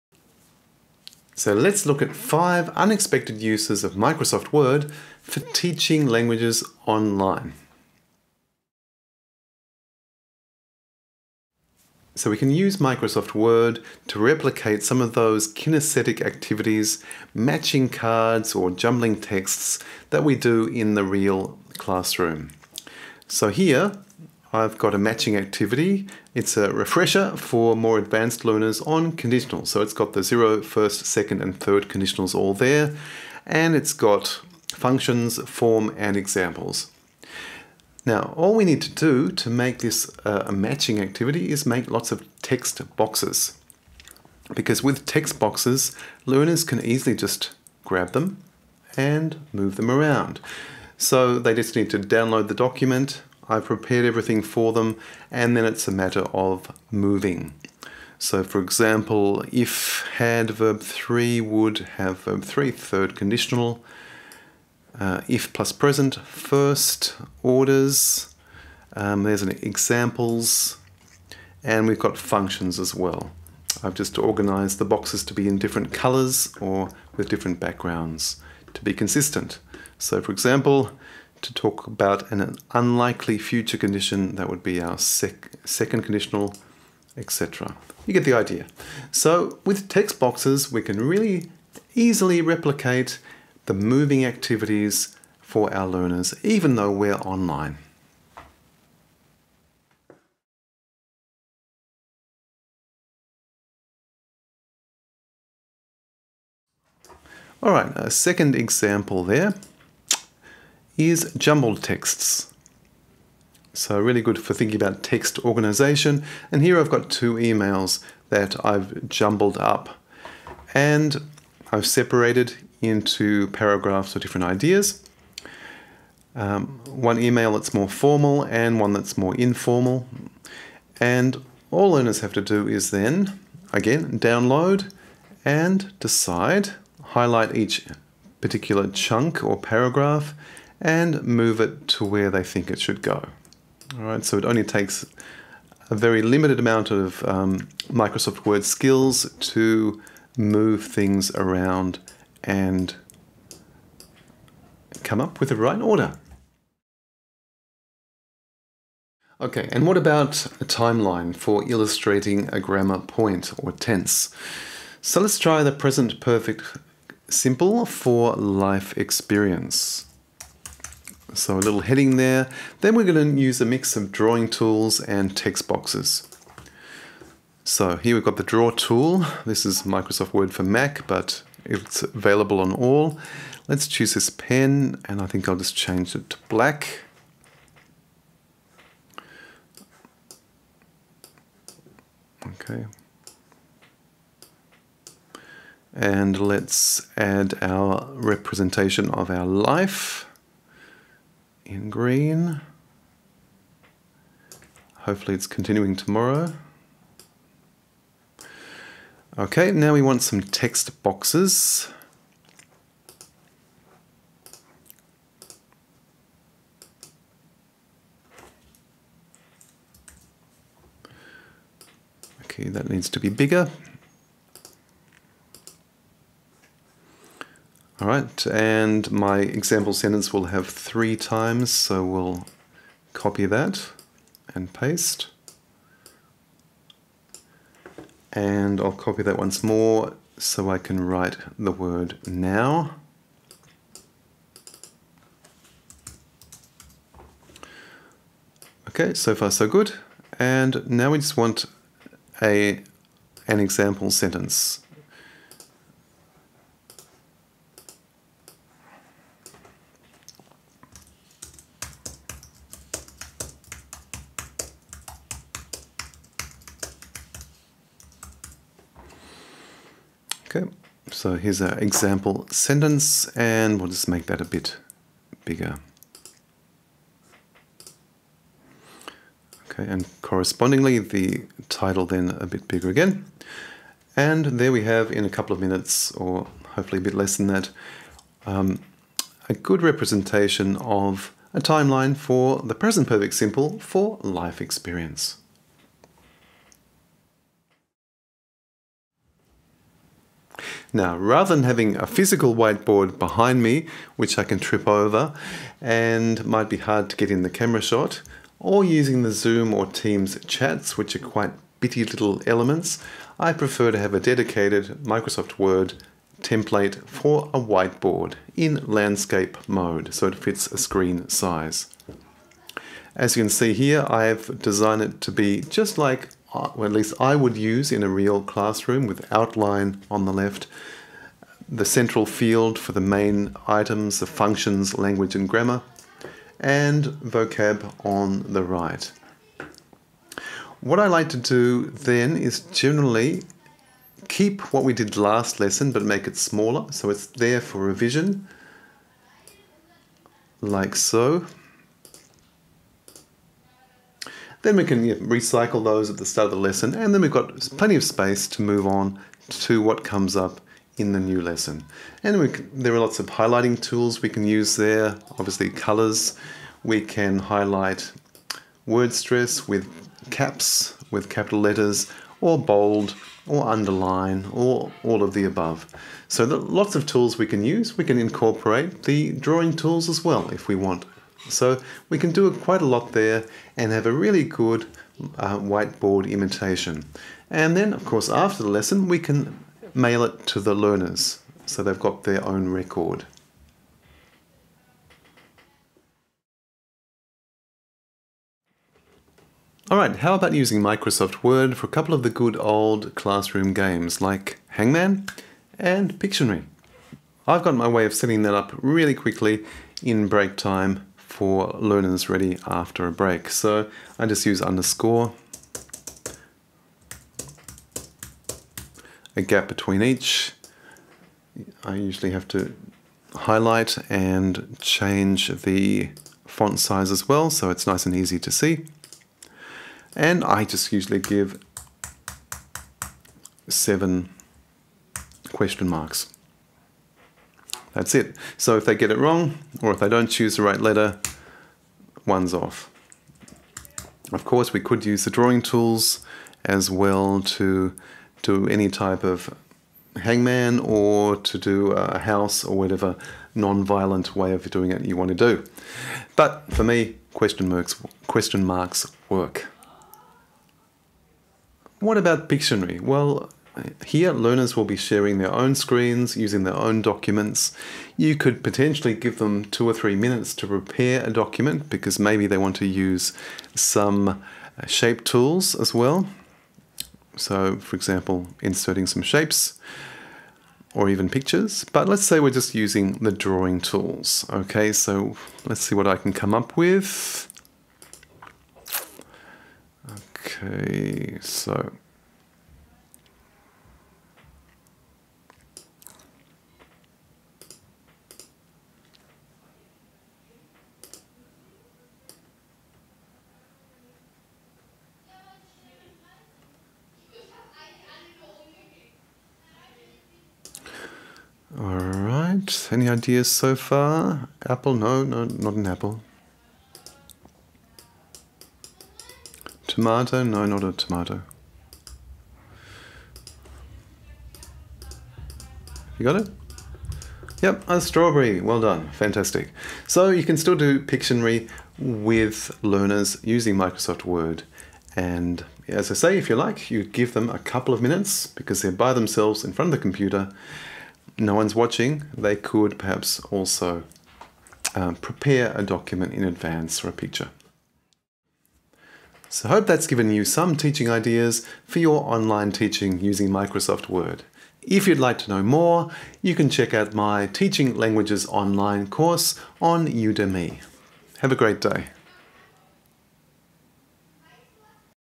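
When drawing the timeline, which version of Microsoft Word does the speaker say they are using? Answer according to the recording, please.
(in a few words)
Microsoft Word for Mac.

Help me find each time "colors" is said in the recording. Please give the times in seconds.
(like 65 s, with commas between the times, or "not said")
75 s, 365 s.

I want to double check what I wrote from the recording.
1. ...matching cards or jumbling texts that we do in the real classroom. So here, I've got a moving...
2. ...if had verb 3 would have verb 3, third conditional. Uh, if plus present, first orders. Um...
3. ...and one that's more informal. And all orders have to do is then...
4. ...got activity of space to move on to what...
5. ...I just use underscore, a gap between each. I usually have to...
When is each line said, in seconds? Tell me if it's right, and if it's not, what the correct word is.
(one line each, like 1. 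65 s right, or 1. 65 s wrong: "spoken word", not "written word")
1. 17 s wrong: "matching", not "moving"
2. 59 s right
3. 128 s wrong: "learners", not "orders"
4. 357 s wrong: "plenty", not "activity"
5. 414 s right.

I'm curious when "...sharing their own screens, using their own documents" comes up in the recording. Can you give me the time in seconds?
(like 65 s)
464 s.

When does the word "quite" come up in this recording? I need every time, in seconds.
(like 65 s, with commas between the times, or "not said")
311 s, 382 s.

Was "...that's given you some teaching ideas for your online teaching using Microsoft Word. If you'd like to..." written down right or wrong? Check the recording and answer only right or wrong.
right.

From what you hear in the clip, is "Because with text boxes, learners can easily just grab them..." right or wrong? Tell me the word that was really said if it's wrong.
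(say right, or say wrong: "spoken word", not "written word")
right.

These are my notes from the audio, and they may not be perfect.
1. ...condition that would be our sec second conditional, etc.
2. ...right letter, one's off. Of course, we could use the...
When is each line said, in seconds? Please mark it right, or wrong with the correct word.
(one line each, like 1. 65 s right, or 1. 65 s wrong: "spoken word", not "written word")
1. 83 s right
2. 440 s right.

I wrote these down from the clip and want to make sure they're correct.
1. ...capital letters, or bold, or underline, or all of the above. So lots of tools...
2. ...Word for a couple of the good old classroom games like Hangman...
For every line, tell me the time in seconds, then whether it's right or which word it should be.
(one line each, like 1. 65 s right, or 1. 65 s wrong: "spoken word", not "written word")
1. 371 s right
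2. 401 s right.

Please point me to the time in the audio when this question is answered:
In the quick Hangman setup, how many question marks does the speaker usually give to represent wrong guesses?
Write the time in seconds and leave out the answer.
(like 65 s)
433 s.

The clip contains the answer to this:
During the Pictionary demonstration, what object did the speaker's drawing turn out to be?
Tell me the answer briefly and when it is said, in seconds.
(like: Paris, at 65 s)
strawberry, at 528 s.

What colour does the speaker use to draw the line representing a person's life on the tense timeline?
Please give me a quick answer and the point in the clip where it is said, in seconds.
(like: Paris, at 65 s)
green, at 201 s.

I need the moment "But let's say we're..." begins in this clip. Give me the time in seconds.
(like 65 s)
481 s.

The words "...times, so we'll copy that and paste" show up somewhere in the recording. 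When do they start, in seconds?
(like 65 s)
231 s.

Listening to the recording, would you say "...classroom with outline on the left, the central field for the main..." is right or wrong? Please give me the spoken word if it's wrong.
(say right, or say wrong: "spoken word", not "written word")
right.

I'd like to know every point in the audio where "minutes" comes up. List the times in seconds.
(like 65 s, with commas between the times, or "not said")
285 s, 470 s, 538 s.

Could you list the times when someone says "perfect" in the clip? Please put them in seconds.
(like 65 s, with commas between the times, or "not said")
166 s, 293 s.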